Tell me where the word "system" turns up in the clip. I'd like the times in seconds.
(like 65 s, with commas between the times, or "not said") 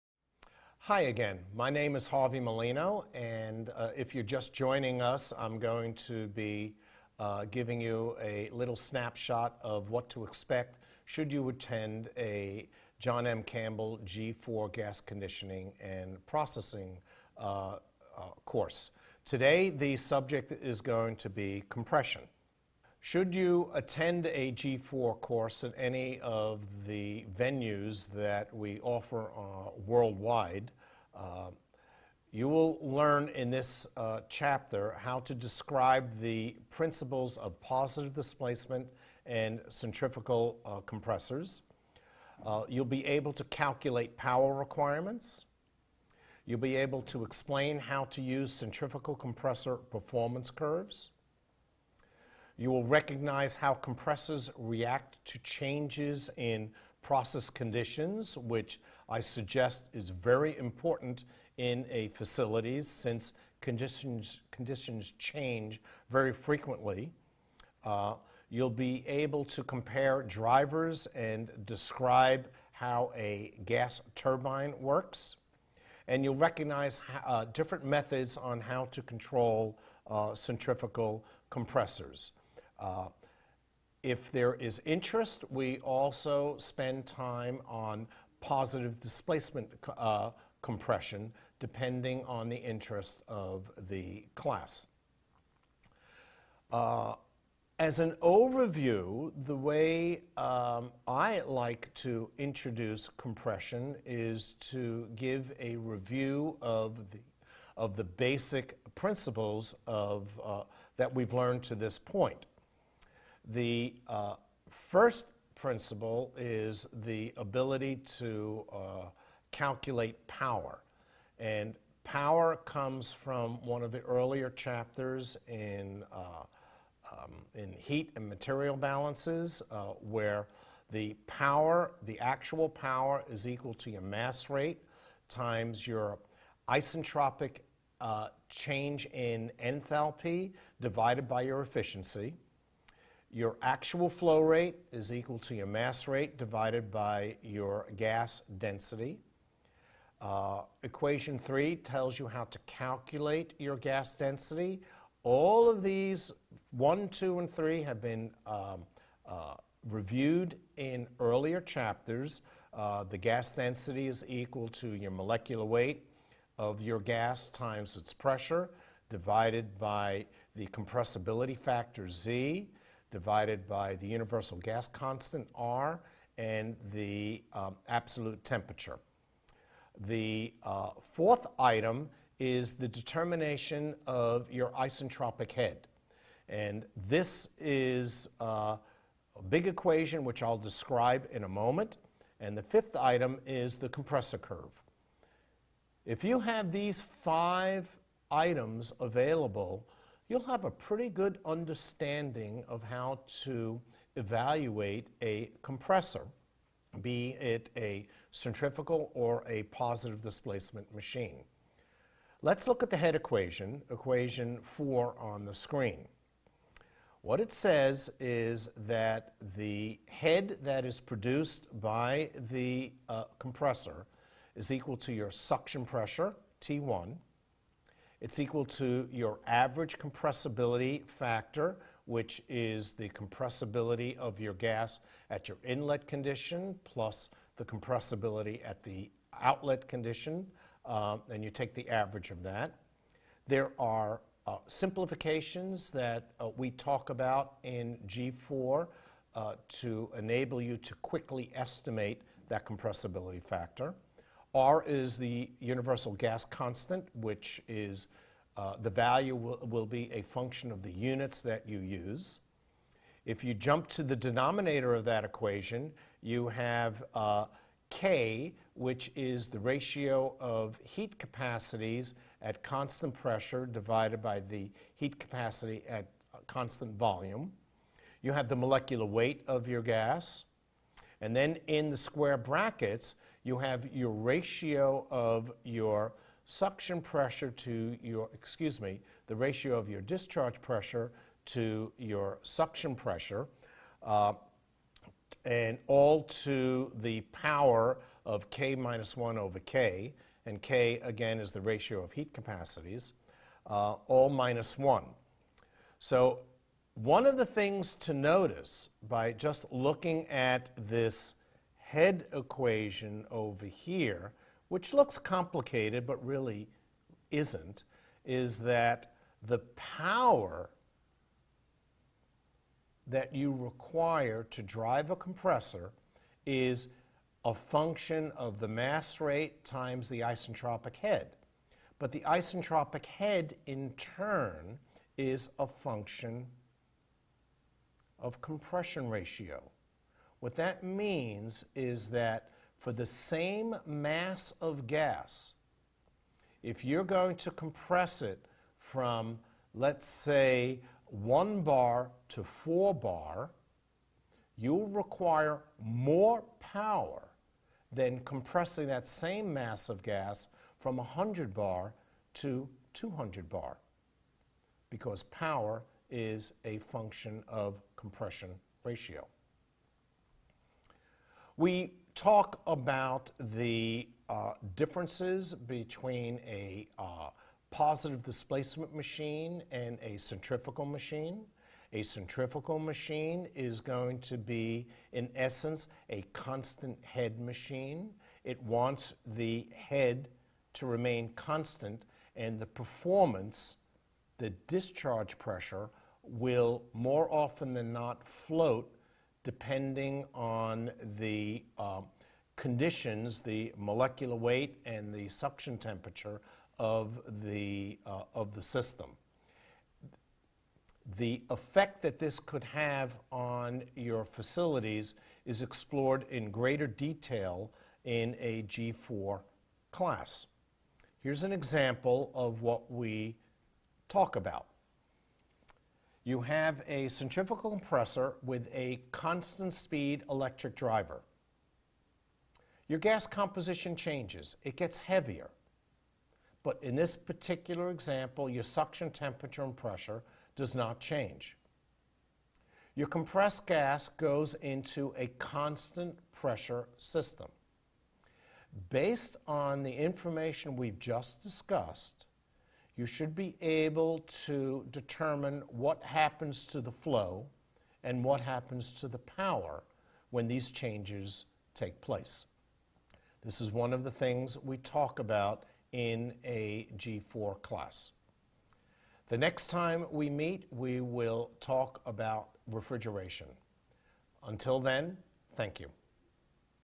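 408 s, 446 s.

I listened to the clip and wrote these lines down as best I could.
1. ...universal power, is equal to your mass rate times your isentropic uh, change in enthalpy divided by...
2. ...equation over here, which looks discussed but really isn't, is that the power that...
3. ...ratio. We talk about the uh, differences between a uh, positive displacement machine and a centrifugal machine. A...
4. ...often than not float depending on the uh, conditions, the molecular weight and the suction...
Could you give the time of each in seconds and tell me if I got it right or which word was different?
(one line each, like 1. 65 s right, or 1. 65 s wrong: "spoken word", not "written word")
1. 132 s wrong: "actual", not "universal"
2. 312 s wrong: "complicated", not "discussed"
3. 368 s right
4. 397 s right.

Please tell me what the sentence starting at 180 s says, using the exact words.
The uh, fourth item is the determination of your isentropic head.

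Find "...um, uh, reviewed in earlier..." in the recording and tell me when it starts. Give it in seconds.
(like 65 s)
158 s.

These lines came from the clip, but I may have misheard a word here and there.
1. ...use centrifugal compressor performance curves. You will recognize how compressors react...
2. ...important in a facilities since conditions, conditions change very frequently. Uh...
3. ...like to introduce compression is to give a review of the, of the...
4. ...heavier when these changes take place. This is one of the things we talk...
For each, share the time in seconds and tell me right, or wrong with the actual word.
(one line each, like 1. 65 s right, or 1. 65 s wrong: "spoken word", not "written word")
1. 48 s right
2. 60 s right
3. 101 s right
4. 459 s wrong: "power", not "heavier".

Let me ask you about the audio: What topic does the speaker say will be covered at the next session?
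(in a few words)
refrigeration.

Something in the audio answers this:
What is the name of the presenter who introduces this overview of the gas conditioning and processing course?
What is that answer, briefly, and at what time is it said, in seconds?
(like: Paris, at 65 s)
Harvey Malino, at 2 s.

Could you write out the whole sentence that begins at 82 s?
Uh, if there is interest, we also spend time on positive displacement uh, compression, depending on the interest of the class.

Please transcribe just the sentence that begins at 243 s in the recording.
There are uh, simplifications that uh, we talk about in G4 uh, to enable you to quickly estimate that compressibility factor.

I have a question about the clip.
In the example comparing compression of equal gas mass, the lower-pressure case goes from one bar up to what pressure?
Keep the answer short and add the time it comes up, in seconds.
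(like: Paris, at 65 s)
4 bar, at 352 s.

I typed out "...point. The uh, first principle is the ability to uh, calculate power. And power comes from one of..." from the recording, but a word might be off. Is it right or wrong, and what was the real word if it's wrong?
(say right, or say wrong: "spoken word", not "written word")
right.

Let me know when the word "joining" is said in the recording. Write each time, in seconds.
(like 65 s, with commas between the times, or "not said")
4 s.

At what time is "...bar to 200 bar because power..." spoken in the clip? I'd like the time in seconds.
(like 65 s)
361 s.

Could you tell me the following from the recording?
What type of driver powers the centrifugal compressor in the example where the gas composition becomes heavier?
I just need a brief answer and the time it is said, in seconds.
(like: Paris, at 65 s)
constant speed electric driver, at 429 s.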